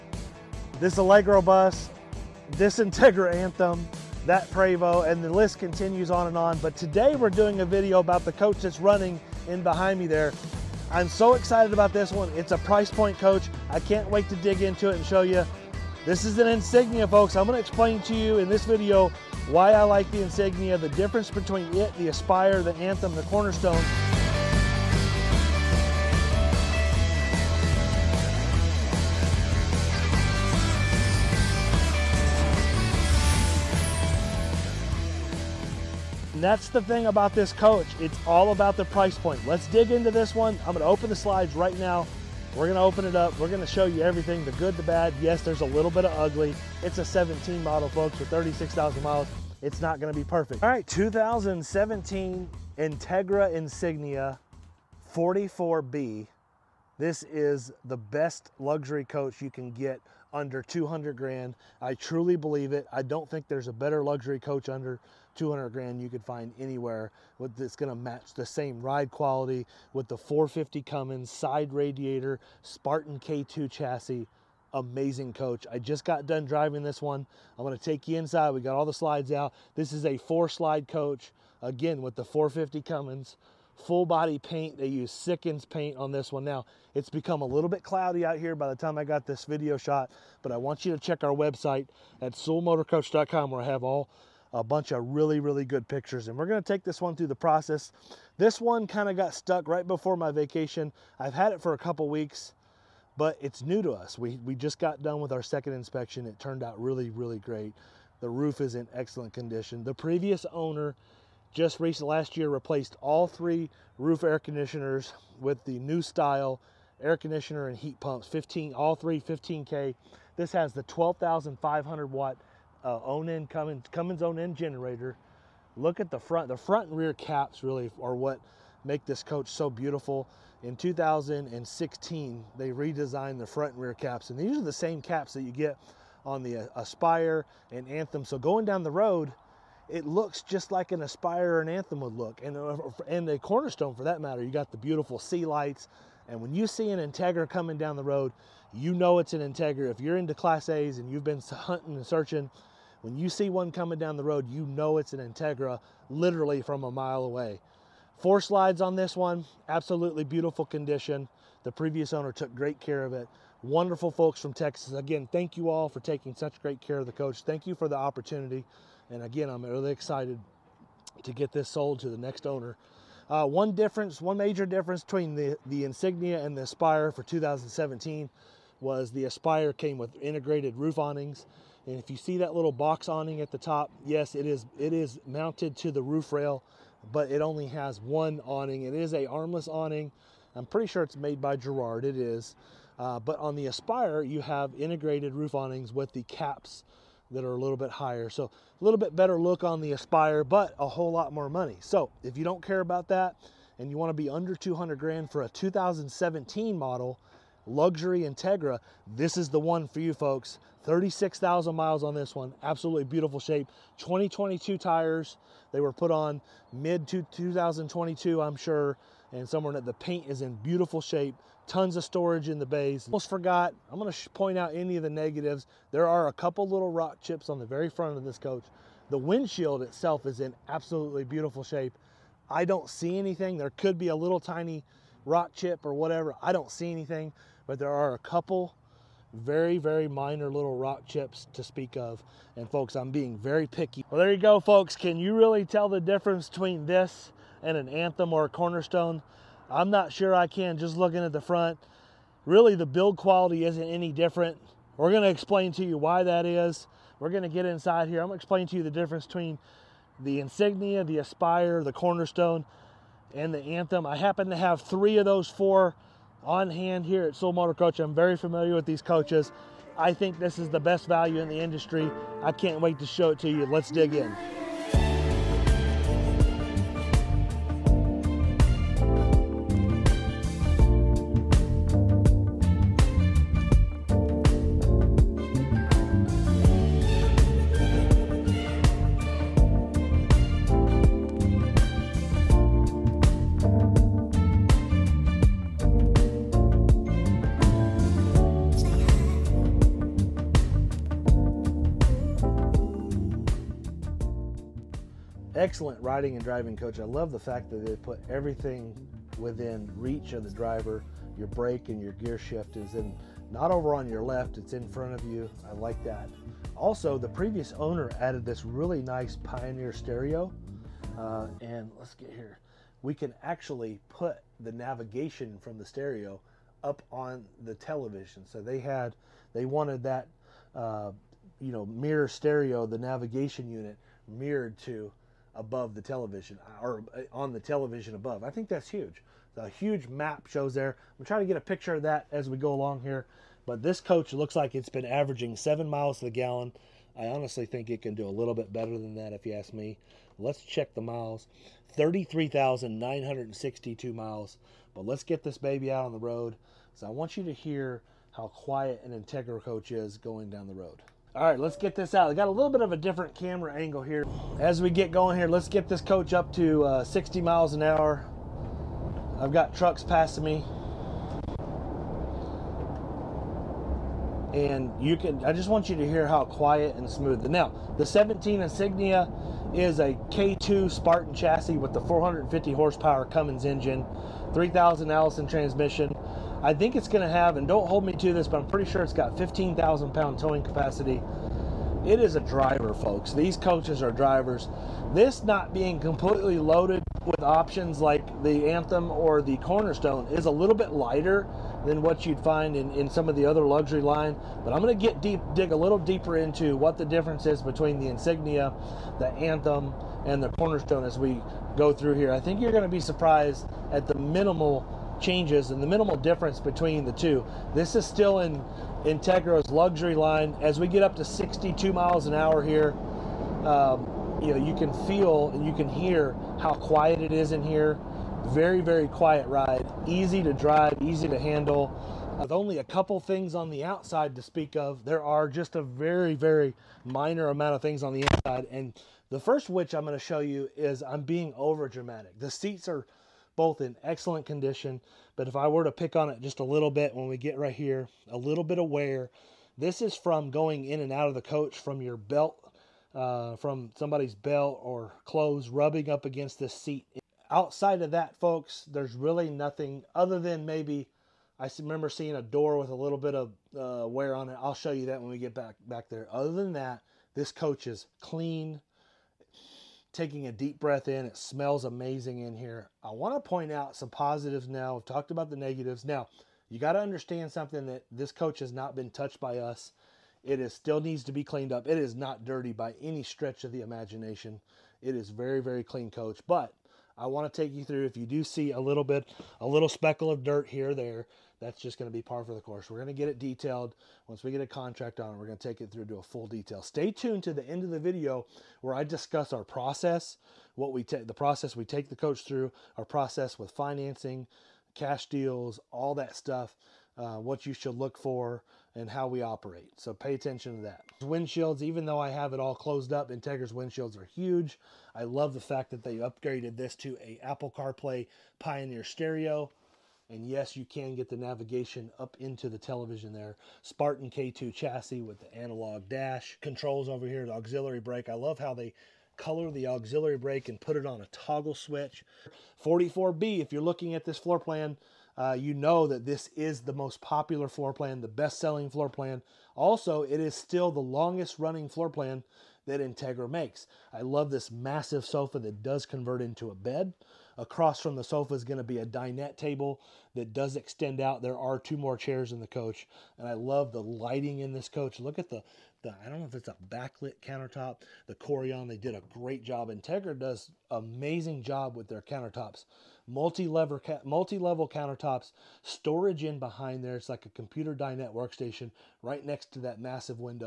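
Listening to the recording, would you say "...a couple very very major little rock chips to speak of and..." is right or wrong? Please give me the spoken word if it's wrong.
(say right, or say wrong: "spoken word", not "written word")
wrong: "minor", not "major".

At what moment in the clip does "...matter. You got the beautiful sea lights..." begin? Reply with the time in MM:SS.
02:24.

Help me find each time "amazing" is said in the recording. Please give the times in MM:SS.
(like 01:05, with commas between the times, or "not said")
01:14, 07:51, 09:20.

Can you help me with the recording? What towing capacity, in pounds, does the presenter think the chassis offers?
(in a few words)
15,000.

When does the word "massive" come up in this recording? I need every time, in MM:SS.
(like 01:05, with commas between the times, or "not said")
09:04, 09:29.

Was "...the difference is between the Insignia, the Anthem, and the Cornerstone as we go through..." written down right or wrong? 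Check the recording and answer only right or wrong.
right.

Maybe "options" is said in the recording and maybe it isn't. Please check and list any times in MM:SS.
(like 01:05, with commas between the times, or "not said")
06:37.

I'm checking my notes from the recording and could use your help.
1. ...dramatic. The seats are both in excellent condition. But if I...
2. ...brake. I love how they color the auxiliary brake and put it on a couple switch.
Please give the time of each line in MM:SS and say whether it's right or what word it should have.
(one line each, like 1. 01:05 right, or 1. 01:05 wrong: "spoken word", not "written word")
1. 07:21 right
2. 08:48 wrong: "toggle", not "couple".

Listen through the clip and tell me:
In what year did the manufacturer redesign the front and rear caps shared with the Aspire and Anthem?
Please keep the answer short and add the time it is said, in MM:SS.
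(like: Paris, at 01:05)
2016, at 02:10.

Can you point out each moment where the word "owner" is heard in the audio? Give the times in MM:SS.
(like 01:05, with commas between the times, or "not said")
01:50, 02:42, 02:52, 05:17.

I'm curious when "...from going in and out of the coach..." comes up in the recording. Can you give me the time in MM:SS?
07:30.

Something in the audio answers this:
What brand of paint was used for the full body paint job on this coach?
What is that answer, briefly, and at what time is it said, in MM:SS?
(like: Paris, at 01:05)
Sikkens, at 01:25.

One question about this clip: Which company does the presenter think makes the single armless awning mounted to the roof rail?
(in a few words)
Girard.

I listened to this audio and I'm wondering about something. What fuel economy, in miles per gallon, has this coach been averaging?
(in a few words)
7.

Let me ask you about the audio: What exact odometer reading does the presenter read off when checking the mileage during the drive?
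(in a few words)
33,962.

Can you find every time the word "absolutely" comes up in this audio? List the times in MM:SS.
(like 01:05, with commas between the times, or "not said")
02:39, 03:32, 03:50.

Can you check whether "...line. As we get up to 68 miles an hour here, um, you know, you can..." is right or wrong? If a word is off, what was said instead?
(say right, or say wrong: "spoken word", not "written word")
wrong: "62", not "68".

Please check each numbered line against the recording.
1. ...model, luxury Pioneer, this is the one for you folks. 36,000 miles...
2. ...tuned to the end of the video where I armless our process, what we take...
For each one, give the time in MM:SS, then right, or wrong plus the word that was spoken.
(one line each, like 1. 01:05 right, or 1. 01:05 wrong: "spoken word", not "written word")
1. 03:26 wrong: "Entegra", not "Pioneer"
2. 08:17 wrong: "discuss", not "armless".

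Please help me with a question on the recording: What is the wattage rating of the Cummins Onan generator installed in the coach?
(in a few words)
12500.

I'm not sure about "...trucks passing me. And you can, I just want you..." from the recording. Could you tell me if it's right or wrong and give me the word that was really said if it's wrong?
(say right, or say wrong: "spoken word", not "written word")
right.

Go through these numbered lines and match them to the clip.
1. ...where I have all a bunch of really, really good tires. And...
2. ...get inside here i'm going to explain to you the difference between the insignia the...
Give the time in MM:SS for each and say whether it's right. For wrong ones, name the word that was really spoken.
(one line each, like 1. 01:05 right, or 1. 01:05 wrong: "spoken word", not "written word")
1. 01:33 wrong: "pictures", not "tires"
2. 04:17 right.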